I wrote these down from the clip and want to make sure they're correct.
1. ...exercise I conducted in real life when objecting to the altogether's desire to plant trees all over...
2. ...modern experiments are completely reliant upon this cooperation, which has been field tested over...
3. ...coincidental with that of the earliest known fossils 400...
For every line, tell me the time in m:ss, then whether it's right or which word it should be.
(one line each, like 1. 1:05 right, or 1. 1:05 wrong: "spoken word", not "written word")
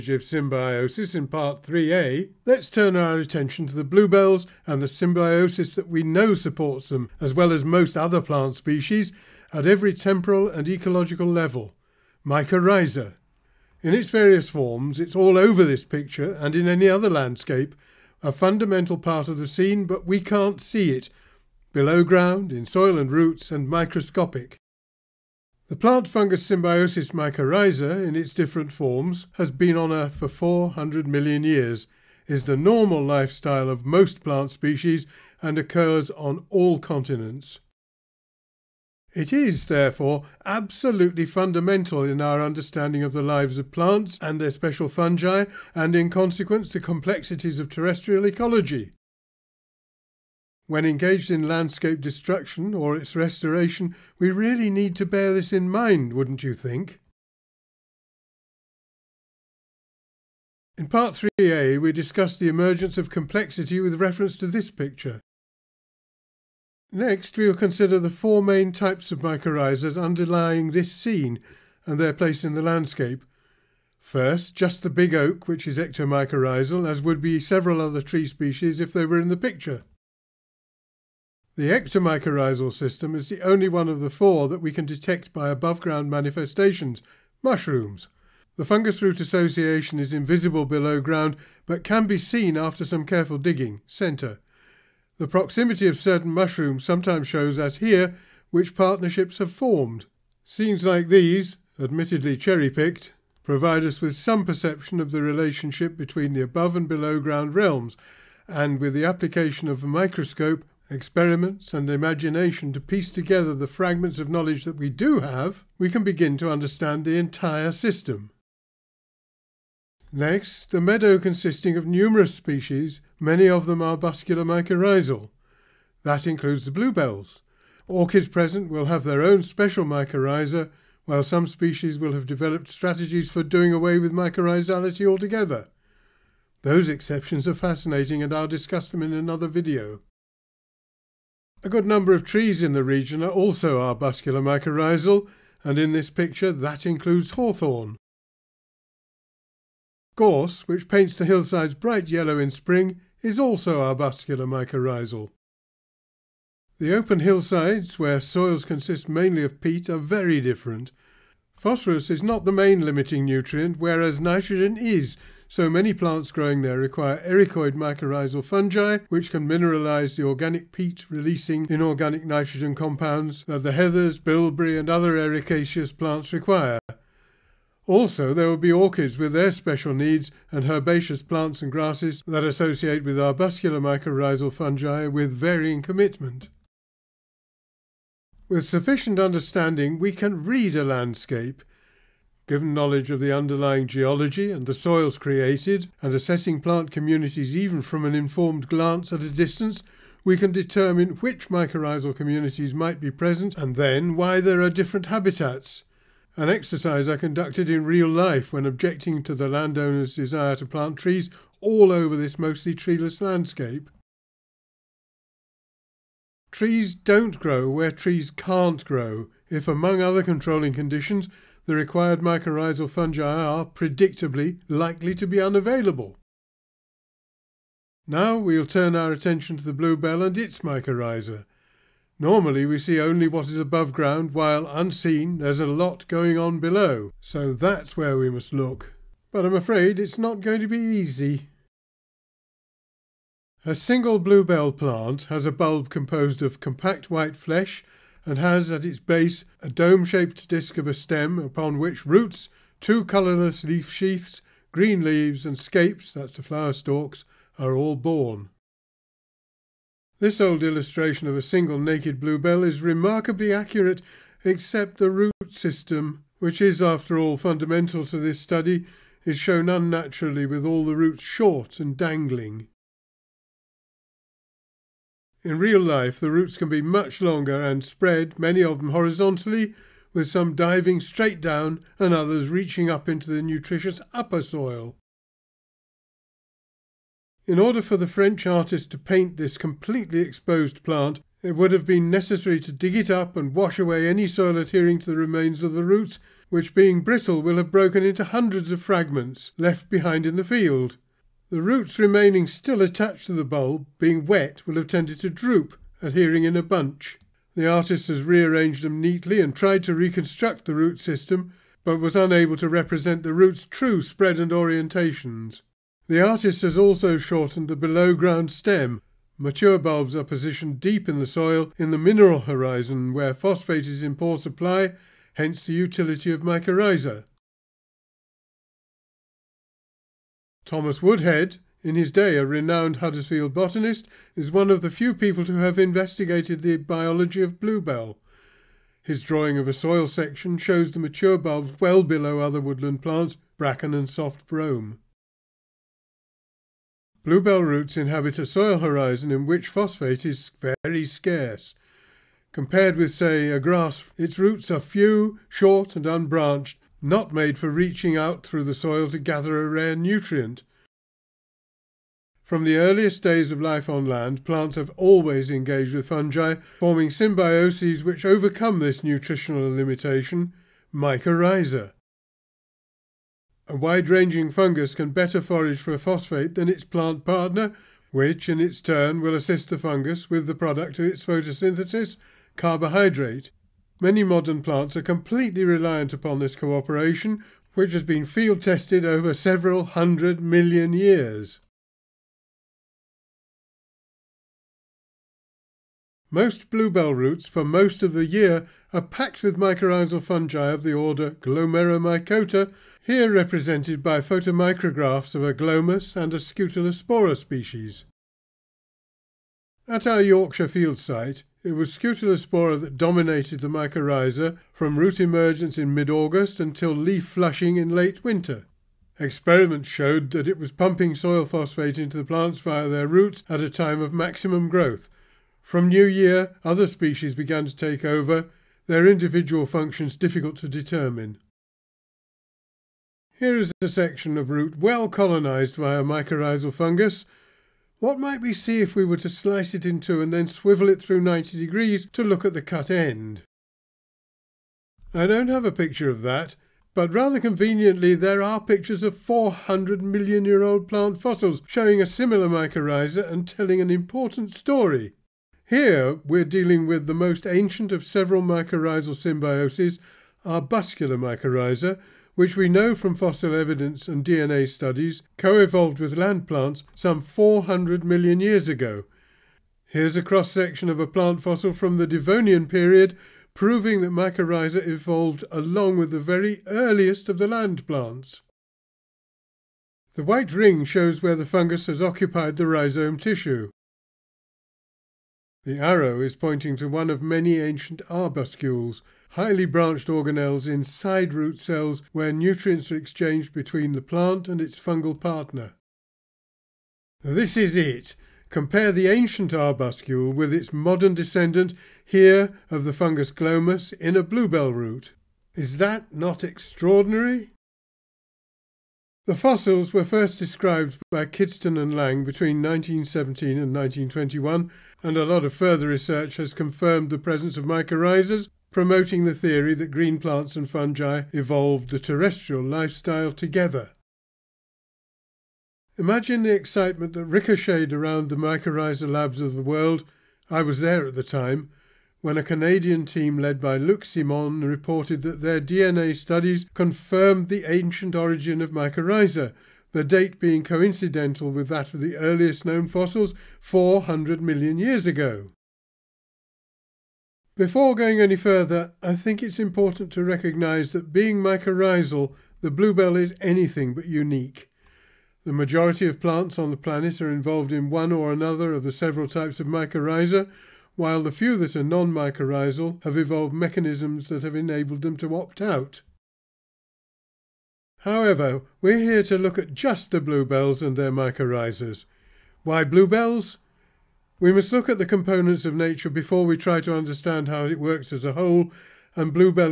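1. 3:26 wrong: "landowner", not "altogether"
2. 6:24 wrong: "plants", not "experiments"
3. 9:00 right.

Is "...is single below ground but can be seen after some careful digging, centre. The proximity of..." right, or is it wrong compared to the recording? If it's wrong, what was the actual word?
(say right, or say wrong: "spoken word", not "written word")
wrong: "invisible", not "single".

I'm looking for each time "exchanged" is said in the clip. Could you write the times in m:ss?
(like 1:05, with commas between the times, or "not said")
8:12.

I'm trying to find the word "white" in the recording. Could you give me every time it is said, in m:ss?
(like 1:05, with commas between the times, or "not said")
4:07, 8:00.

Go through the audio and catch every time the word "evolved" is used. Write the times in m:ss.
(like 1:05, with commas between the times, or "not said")
7:45, 7:54, 8:41, 9:23.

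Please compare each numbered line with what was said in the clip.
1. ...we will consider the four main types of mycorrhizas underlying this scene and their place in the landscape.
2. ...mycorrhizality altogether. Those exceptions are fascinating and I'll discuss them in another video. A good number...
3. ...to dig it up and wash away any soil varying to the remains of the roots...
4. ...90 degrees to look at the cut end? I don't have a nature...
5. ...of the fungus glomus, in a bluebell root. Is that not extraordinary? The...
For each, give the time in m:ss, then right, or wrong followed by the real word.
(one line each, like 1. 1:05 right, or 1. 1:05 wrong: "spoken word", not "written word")
1. 1:07 right
2. 2:14 right
3. 4:52 wrong: "adhering", not "varying"
4. 7:21 wrong: "picture", not "nature"
5. 8:22 right.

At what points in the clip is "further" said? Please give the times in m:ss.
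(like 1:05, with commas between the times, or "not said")
8:35, 9:08.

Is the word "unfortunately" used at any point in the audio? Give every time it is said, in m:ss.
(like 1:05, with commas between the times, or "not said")
not said.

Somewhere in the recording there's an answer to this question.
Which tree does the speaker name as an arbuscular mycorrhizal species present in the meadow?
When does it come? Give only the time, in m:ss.
2:27.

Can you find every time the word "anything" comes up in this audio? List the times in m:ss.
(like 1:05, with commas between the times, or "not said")
9:13.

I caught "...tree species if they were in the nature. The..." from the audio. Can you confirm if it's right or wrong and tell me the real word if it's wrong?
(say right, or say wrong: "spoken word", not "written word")
wrong: "picture", not "nature".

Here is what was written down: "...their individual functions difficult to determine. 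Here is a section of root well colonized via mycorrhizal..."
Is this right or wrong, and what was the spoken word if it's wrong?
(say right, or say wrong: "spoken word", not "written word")
right.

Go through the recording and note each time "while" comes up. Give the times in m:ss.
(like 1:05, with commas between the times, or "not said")
2:11, 3:54, 9:20.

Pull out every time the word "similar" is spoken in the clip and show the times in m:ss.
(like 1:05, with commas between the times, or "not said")
7:32.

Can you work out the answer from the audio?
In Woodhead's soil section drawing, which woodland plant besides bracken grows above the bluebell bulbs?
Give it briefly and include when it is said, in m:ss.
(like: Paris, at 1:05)
Soft brome, at 5:44.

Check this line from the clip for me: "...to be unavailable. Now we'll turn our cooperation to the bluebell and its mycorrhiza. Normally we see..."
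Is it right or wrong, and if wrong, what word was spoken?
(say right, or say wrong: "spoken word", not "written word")
wrong: "attention", not "cooperation".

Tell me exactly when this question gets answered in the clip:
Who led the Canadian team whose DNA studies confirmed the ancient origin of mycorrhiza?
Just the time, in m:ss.
8:53.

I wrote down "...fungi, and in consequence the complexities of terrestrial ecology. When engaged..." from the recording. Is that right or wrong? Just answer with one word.
right.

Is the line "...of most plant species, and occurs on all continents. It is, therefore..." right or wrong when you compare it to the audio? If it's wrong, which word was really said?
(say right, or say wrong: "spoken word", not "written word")
right.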